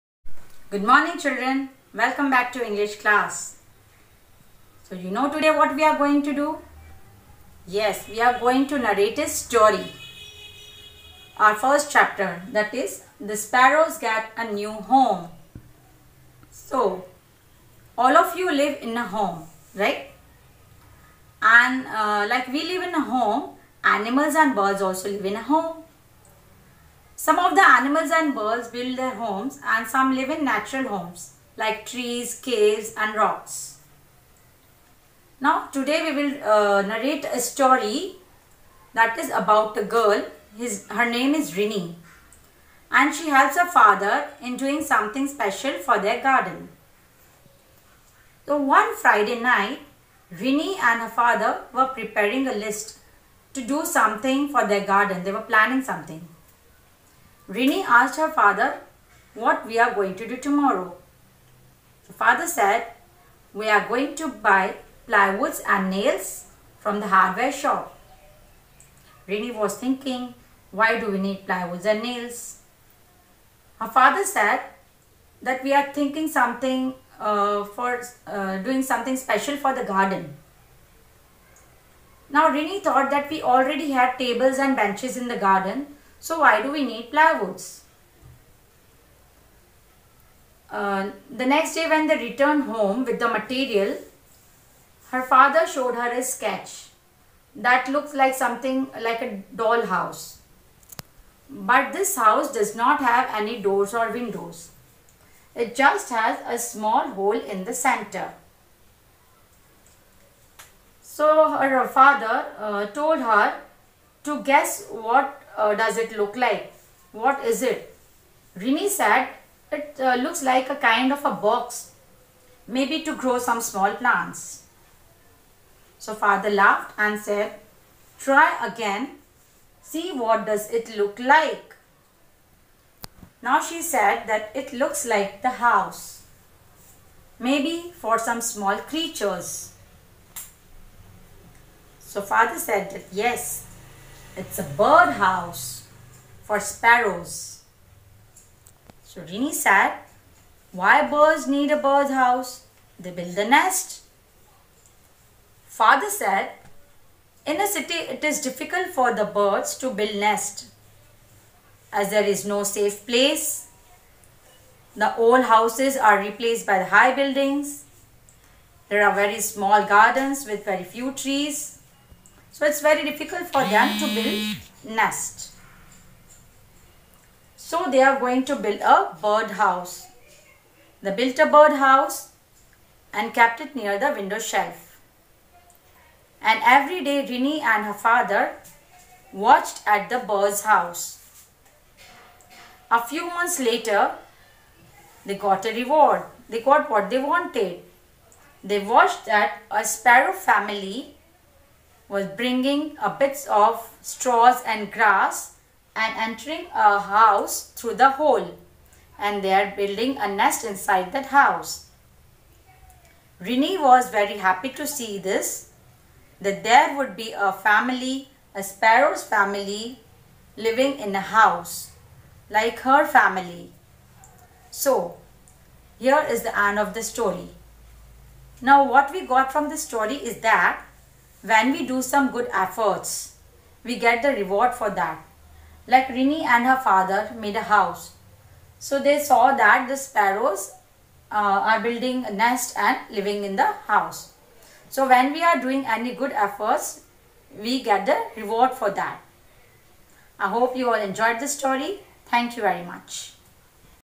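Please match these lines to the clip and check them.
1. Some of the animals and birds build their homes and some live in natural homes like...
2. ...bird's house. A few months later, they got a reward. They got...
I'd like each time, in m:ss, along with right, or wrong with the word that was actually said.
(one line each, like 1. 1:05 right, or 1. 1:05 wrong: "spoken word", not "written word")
1. 0:27 right
2. 3:10 right.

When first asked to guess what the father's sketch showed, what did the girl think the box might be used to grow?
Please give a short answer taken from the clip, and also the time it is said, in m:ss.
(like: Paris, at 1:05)
Small plants, at 2:03.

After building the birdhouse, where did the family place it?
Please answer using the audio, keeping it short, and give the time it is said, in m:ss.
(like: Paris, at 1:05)
Near the window shelf, at 3:03.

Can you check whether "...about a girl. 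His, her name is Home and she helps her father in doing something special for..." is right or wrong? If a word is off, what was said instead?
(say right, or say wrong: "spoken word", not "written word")
wrong: "Rini", not "Home".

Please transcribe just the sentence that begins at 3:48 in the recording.
Now what we got from the story is that when we do some good efforts, we get the reward for that.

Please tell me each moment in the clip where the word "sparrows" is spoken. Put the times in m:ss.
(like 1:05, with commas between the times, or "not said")
0:13, 2:26, 3:19, 3:38, 3:59.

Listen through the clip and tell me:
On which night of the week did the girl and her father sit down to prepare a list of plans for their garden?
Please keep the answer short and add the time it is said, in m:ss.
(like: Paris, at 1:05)
Friday, at 0:48.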